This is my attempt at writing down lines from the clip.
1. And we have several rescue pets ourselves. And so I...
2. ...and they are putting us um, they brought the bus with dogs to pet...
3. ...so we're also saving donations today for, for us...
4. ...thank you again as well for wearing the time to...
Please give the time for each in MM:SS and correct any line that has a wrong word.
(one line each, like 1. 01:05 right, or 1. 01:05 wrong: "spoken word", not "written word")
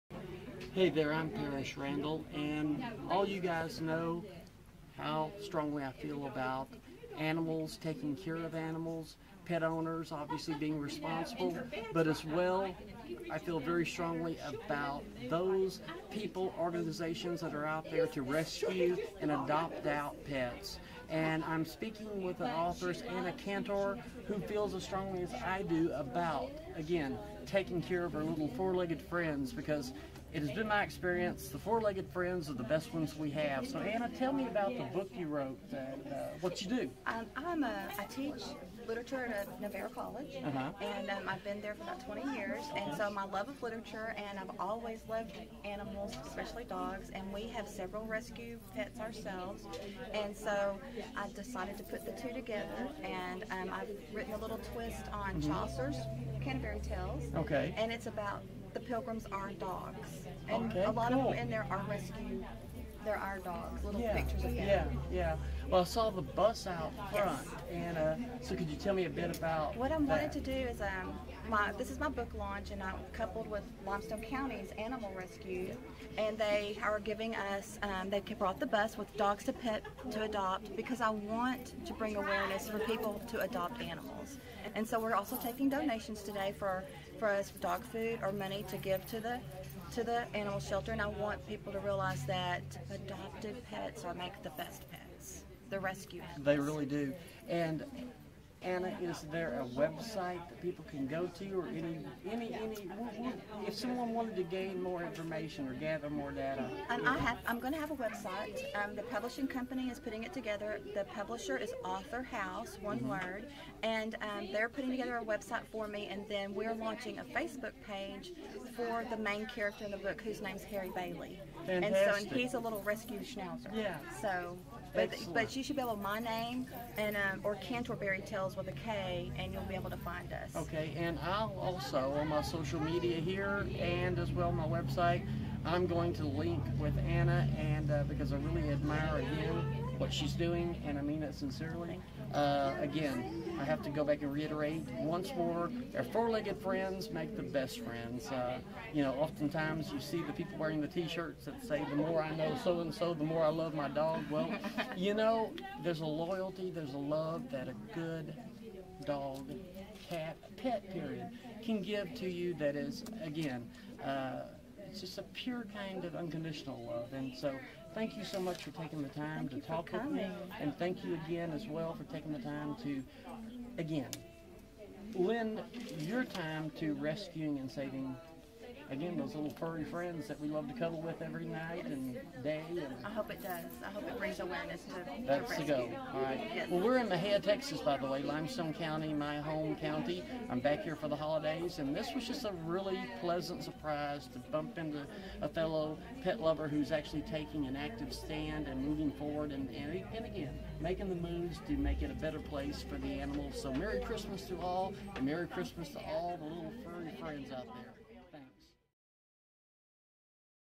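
1. 00:47 right
2. 01:16 wrong: "giving", not "putting"
3. 01:24 wrong: "taking", not "saving"
4. 02:50 wrong: "taking", not "wearing".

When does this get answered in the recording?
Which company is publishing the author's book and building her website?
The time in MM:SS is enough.
01:51.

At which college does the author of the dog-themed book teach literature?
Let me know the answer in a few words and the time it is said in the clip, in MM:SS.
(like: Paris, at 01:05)
Navarro College, at 00:39.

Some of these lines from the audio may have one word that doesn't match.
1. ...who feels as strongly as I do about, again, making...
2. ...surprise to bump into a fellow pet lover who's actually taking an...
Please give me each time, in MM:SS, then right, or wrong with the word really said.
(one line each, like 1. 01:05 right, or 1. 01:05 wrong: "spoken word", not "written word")
1. 00:24 wrong: "taking", not "making"
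2. 03:13 right.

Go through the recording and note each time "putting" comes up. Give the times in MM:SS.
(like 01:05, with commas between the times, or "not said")
01:49, 01:54.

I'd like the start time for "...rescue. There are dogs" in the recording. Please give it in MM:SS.
01:01.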